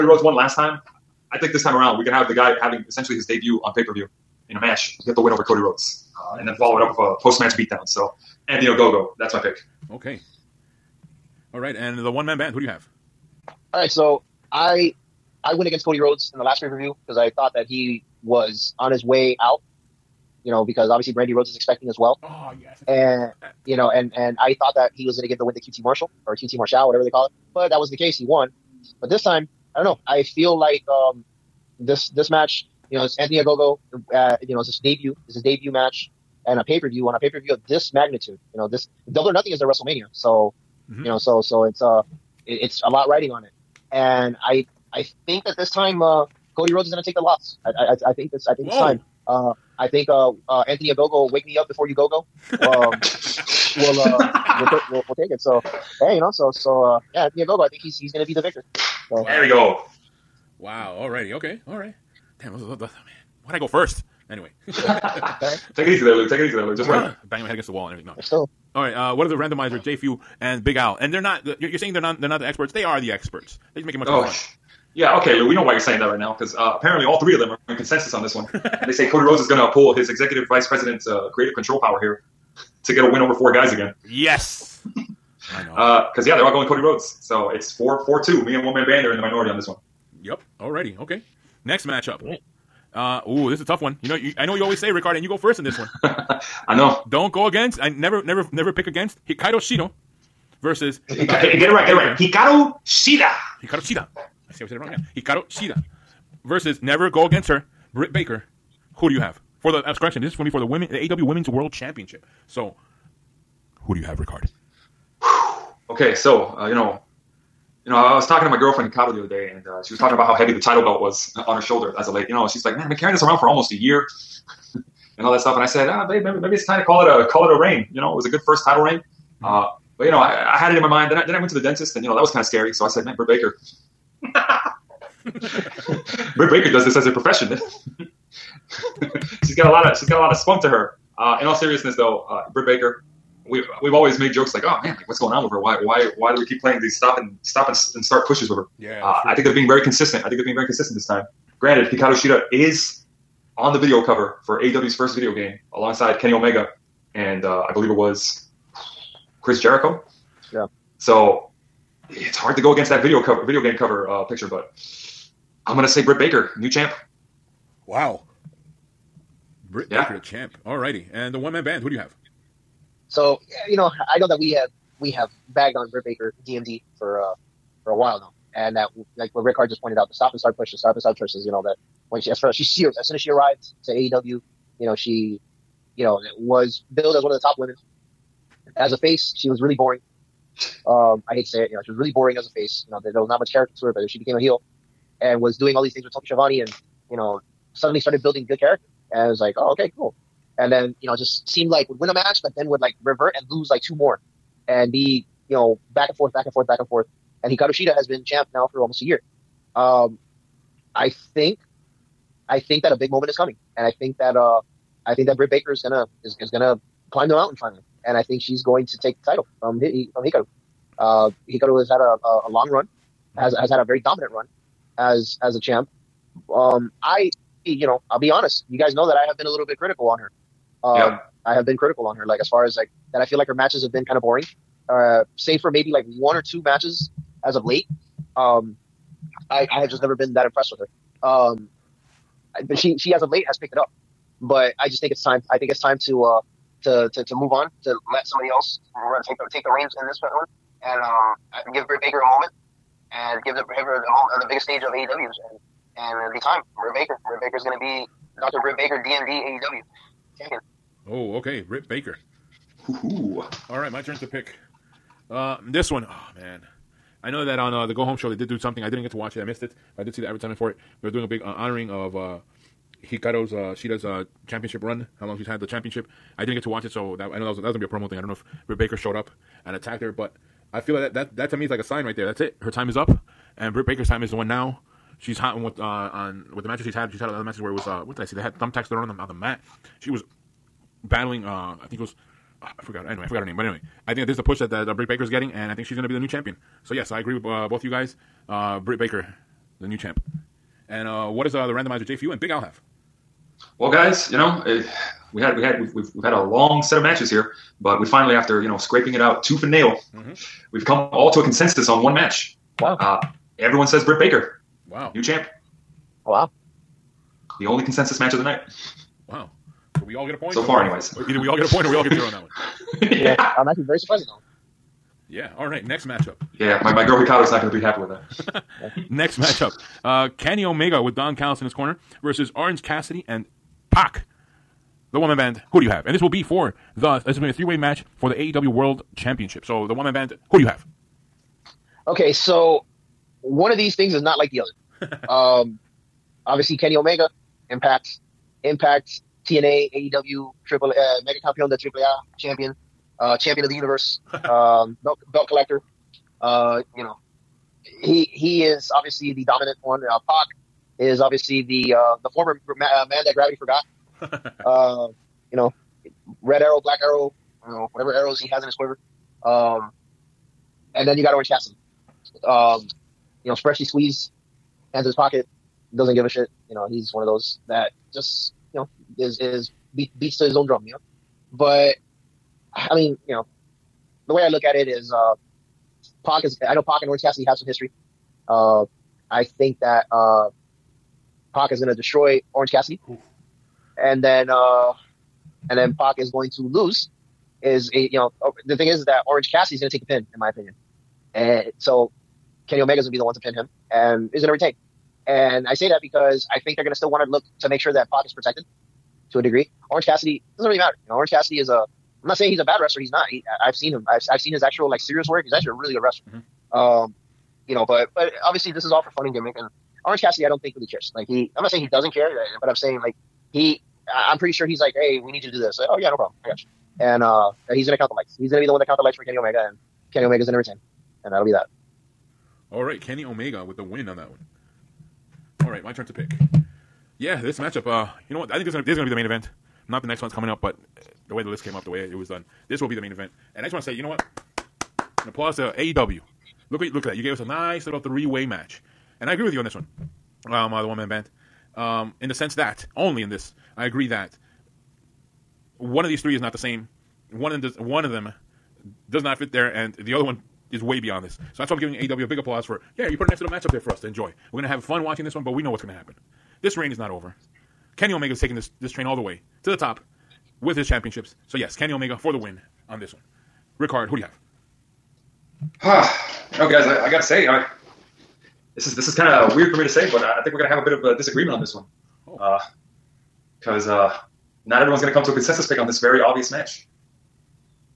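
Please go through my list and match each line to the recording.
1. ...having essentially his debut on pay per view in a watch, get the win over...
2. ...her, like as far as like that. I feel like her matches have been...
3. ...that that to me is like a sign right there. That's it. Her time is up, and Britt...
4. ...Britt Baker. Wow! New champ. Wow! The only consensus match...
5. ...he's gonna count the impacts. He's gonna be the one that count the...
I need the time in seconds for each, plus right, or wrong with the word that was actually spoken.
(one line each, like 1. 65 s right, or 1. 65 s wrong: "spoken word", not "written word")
1. 2 s wrong: "match", not "watch"
2. 232 s right
3. 281 s right
4. 314 s right
5. 427 s wrong: "lights", not "impacts".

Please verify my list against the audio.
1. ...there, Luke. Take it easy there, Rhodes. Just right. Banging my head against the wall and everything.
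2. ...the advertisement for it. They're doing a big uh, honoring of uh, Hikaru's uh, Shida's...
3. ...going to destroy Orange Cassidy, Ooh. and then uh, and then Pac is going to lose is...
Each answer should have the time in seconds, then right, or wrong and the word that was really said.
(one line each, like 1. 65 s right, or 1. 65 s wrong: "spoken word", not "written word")
1. 66 s wrong: "Luke", not "Rhodes"
2. 270 s right
3. 391 s right.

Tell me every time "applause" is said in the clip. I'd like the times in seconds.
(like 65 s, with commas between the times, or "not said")
445 s, 462 s.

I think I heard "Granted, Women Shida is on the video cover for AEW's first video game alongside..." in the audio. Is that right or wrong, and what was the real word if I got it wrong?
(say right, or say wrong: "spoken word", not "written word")
wrong: "Hikaru", not "Women".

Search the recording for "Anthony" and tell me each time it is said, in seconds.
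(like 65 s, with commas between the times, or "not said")
8 s, 33 s, 50 s, 57 s.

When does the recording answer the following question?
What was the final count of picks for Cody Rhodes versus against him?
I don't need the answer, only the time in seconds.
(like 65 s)
87 s.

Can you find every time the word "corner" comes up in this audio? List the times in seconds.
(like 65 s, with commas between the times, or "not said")
331 s.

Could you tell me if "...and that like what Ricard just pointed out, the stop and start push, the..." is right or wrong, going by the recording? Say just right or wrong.
right.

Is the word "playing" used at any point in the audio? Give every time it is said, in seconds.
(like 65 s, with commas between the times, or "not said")
146 s.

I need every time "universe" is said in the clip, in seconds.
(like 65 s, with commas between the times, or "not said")
353 s.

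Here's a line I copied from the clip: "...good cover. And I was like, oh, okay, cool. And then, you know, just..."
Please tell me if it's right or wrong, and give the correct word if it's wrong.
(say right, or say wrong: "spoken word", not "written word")
wrong: "character", not "cover".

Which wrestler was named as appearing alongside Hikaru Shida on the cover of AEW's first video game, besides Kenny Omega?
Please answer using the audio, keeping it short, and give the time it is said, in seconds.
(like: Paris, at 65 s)
Chris Jericho, at 159 s.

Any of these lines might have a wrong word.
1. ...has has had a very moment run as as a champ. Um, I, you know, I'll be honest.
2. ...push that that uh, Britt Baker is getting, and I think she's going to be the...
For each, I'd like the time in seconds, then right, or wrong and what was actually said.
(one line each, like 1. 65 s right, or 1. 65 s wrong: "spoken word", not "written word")
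1. 223 s wrong: "dominant", not "moment"
2. 294 s right.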